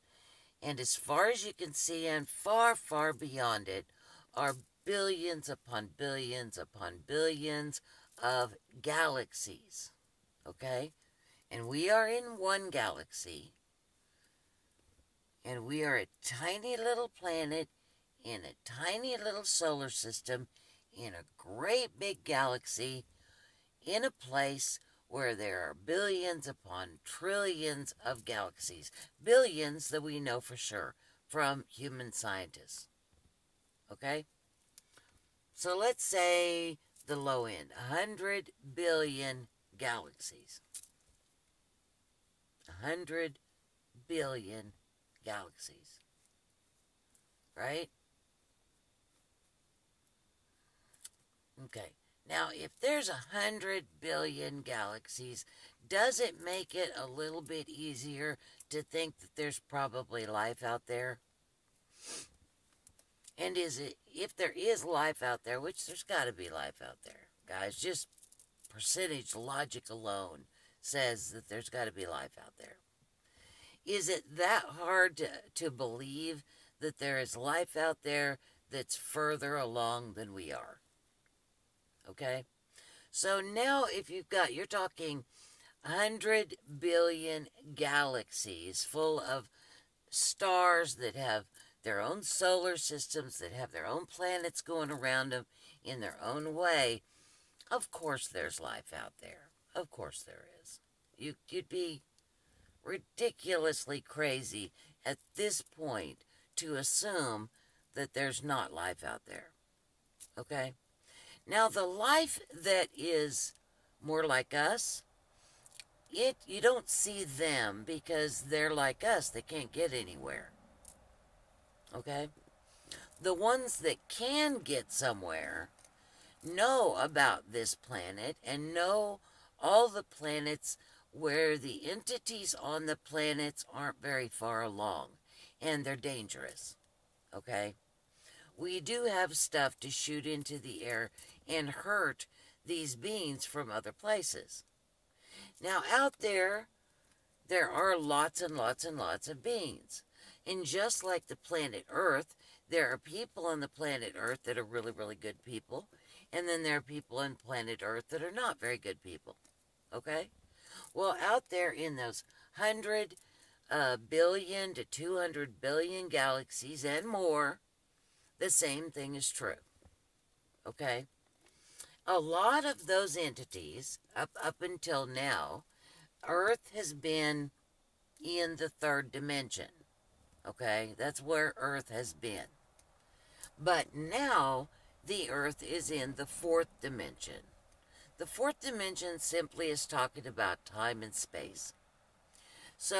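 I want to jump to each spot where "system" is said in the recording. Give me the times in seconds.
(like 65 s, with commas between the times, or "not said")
19 s, 92 s.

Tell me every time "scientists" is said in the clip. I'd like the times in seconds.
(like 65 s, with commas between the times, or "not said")
32 s.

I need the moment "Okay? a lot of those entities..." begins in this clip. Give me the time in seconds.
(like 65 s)
170 s.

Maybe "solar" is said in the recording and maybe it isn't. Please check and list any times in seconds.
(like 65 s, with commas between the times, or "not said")
19 s, 92 s.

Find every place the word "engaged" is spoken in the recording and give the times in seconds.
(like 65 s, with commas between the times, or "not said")
not said.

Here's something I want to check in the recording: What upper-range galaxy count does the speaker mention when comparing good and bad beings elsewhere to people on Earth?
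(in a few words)
200 billion.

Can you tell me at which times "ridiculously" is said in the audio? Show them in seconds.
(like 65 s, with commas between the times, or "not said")
102 s.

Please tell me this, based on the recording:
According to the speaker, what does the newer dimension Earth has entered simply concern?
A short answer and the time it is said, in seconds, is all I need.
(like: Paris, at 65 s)
time and space, at 190 s.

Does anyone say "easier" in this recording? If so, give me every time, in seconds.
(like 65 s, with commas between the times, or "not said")
57 s.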